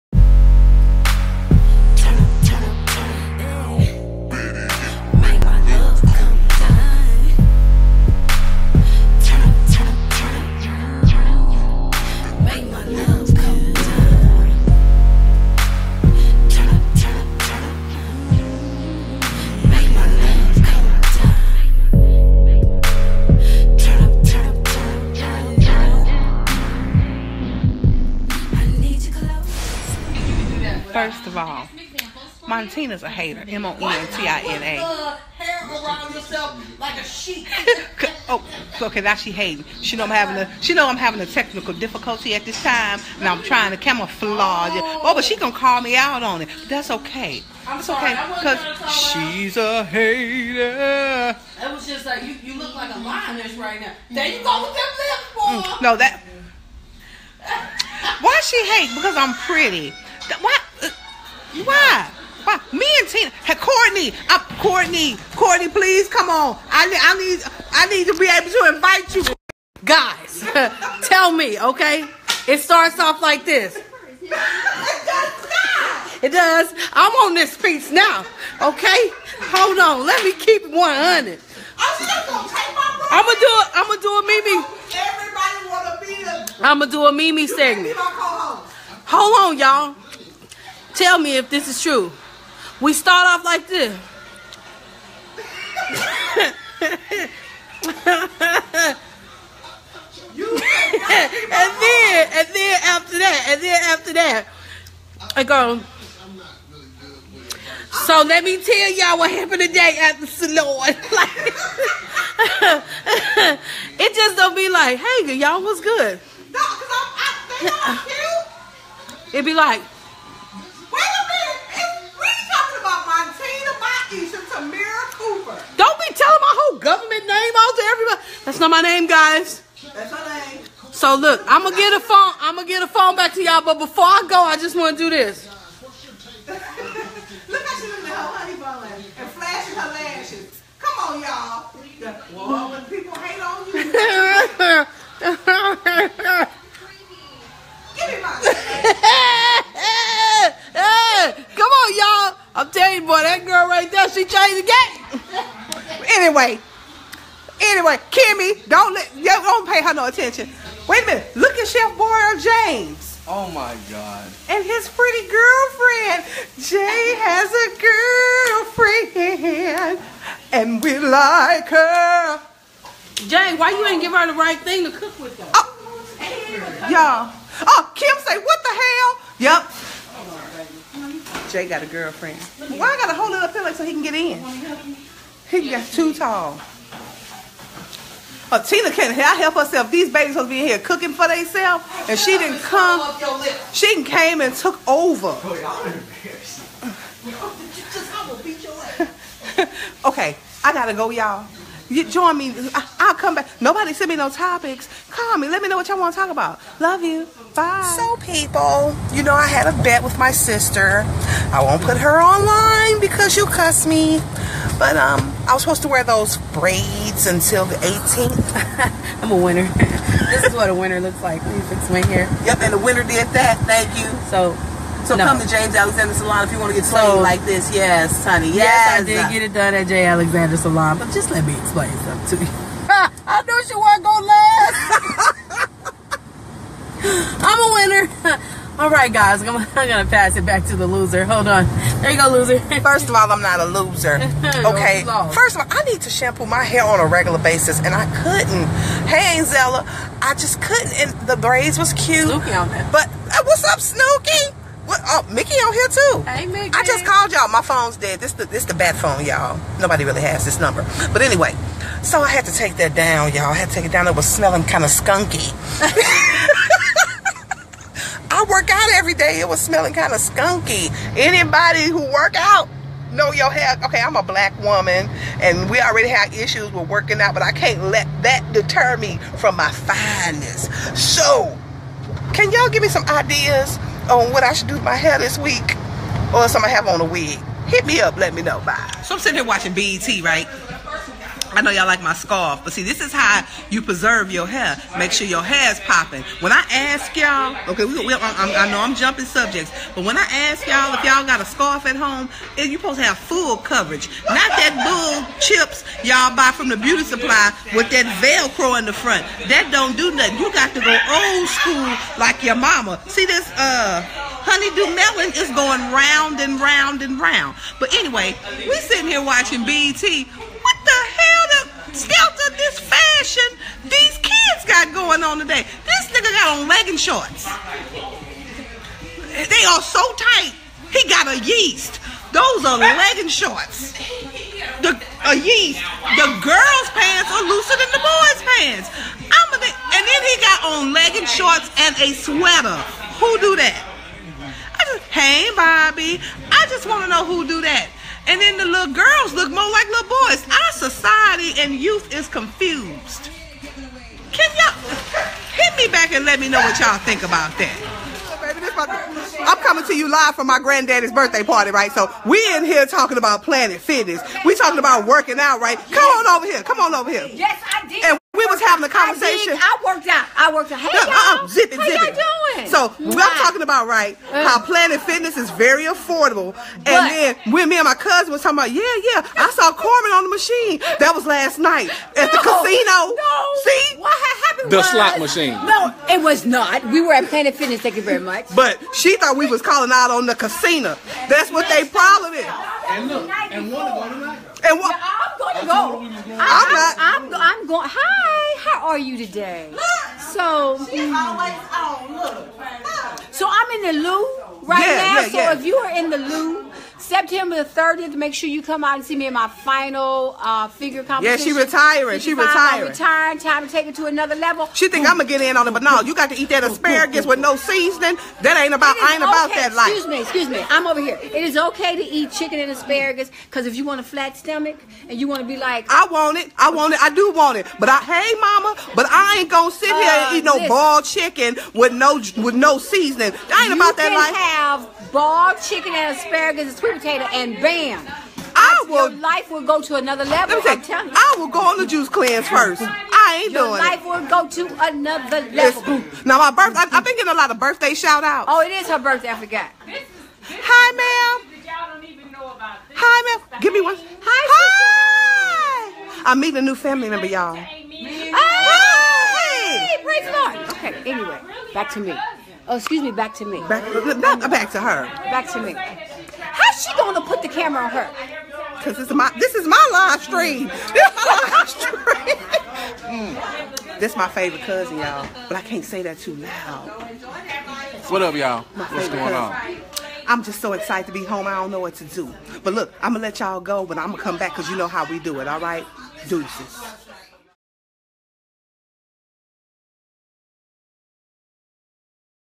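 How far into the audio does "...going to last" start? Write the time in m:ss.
3:54.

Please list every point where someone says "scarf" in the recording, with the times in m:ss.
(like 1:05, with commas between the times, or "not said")
4:52, 5:01.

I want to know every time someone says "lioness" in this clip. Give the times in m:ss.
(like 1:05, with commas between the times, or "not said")
0:52.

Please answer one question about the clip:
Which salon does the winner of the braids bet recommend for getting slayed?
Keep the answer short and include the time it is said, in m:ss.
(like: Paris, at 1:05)
James Alexander Salon, at 3:45.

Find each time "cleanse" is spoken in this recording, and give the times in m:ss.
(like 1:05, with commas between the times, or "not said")
7:22.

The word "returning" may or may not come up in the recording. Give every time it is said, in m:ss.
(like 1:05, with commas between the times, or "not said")
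not said.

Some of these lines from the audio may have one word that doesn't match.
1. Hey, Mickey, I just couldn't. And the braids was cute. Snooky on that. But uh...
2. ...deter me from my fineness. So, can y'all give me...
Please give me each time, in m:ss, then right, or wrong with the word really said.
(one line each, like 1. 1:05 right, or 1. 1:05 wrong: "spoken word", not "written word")
1. 4:09 wrong: "Zella", not "Mickey"
2. 4:38 right.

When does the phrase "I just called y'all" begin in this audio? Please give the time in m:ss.
4:16.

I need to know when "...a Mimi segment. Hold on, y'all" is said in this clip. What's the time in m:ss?
1:27.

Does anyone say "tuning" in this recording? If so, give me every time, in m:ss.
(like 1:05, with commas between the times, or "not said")
not said.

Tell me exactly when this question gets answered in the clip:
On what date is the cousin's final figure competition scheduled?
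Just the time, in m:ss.
6:47.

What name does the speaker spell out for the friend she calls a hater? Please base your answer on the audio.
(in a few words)
Montina.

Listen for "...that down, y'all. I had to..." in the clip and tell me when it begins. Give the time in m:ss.
4:22.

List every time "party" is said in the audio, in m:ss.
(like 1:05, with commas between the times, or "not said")
6:01.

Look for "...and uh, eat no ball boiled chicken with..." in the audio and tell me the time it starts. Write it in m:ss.
7:10.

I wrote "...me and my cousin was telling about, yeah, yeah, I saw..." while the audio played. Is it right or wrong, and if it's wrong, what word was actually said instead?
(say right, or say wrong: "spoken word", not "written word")
wrong: "talking", not "telling".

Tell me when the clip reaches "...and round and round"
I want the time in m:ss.
5:16.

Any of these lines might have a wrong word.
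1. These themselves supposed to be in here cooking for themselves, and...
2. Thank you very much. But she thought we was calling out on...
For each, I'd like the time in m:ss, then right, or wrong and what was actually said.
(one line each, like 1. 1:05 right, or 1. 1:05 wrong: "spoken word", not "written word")
1. 3:09 wrong: "babies", not "themselves"
2. 6:27 right.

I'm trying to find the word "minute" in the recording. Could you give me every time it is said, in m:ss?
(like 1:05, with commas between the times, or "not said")
2:41.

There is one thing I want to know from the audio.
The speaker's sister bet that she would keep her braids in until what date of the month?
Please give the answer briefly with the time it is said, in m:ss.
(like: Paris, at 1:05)
the 18th, at 3:37.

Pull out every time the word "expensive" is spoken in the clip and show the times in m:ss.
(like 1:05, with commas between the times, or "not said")
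not said.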